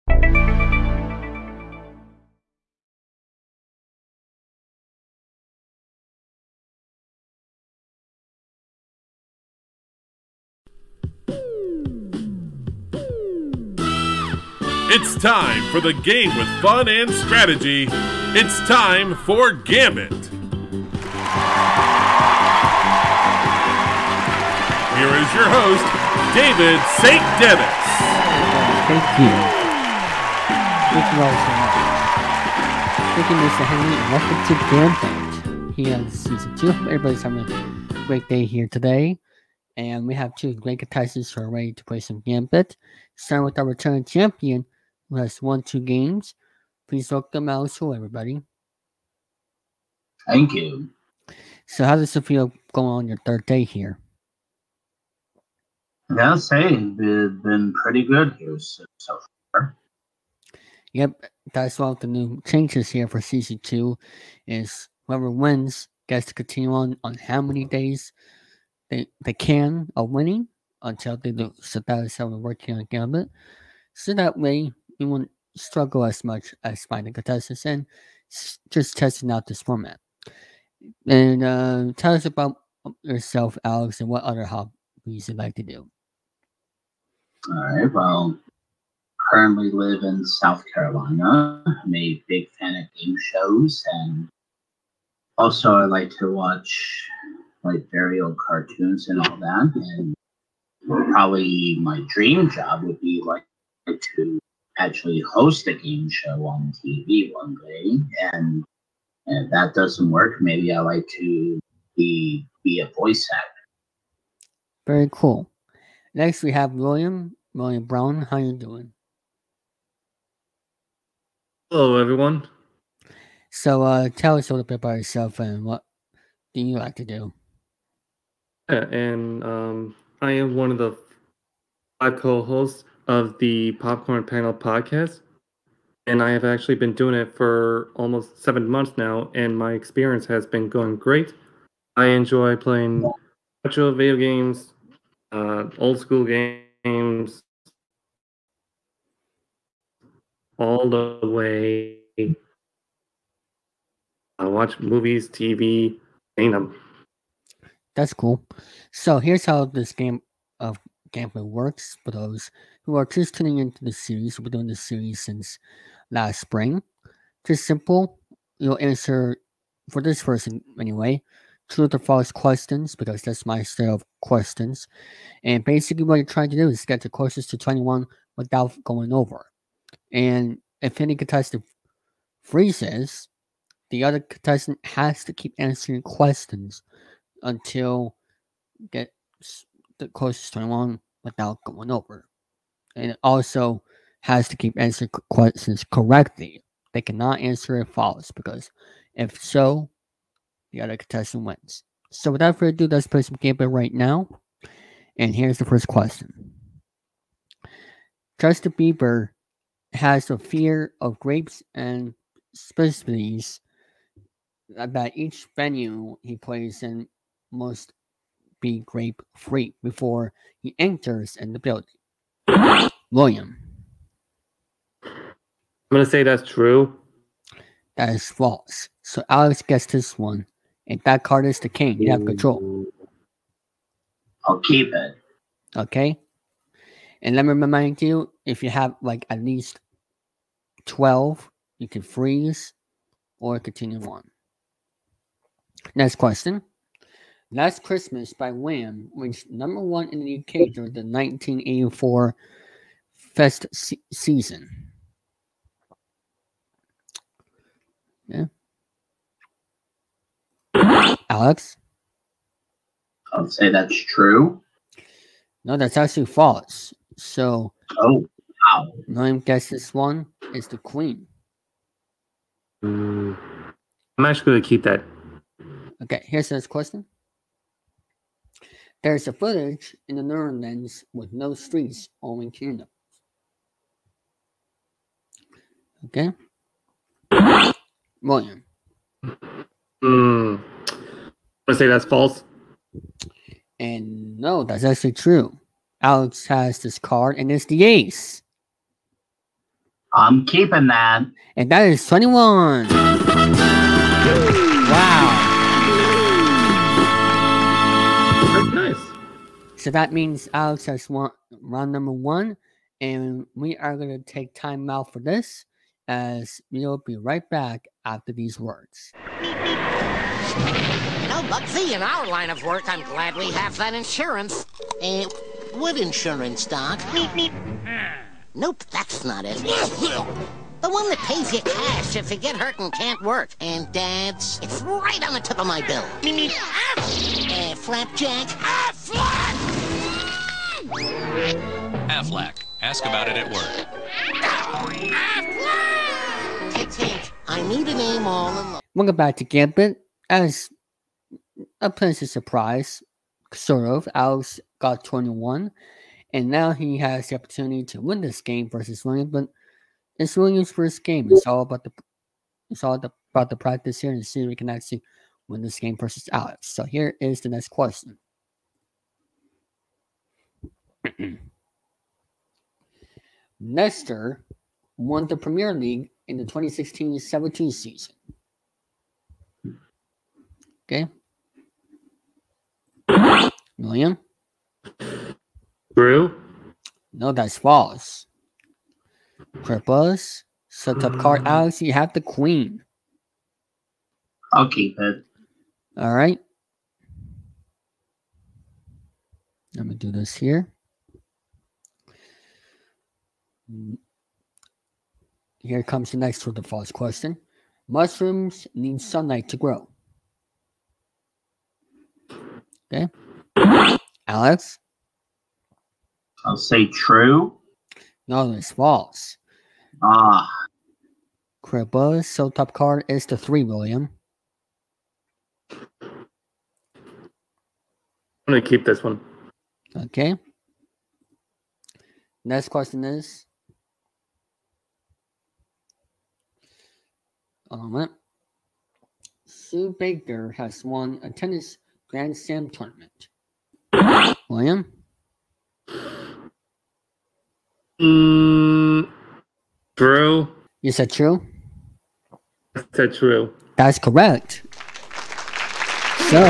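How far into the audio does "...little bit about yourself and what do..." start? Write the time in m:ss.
2:04.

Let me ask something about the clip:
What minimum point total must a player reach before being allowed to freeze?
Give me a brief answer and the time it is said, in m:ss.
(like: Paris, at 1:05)
12, at 4:00.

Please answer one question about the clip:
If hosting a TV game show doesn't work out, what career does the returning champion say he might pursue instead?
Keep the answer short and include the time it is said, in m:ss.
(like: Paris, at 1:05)
voice actor, at 1:52.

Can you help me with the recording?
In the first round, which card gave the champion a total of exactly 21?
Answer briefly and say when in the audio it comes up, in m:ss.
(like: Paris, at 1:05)
ace, at 4:57.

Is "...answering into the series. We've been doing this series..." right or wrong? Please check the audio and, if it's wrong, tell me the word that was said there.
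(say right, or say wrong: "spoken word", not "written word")
wrong: "tuning", not "answering".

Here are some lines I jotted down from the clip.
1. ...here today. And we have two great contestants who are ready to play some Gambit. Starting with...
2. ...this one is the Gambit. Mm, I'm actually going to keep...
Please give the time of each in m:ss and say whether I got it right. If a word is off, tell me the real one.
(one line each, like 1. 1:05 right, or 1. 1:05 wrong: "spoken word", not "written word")
1. 0:38 right
2. 4:29 wrong: "Queen", not "Gambit".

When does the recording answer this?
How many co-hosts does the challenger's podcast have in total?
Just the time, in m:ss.
2:12.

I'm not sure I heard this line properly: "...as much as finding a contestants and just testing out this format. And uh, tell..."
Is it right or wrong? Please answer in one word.
right.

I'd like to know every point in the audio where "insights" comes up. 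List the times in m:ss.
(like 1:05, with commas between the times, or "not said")
not said.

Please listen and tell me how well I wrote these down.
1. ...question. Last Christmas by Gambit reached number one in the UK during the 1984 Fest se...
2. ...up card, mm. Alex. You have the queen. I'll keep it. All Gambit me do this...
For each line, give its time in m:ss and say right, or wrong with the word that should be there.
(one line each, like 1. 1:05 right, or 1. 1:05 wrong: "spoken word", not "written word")
1. 4:06 wrong: "Wham", not "Gambit"
2. 6:31 wrong: "Let", not "Gambit".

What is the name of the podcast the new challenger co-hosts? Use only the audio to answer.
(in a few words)
Popcorn Panel.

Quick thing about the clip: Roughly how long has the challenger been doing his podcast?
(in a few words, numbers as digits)
almost 7 months.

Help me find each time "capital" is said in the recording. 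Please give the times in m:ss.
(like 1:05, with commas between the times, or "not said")
not said.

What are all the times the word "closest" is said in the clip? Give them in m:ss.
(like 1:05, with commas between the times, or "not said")
2:57, 3:10.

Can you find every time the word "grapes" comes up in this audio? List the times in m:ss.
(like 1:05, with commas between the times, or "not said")
3:31, 3:38.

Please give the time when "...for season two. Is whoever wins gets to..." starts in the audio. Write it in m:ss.
1:03.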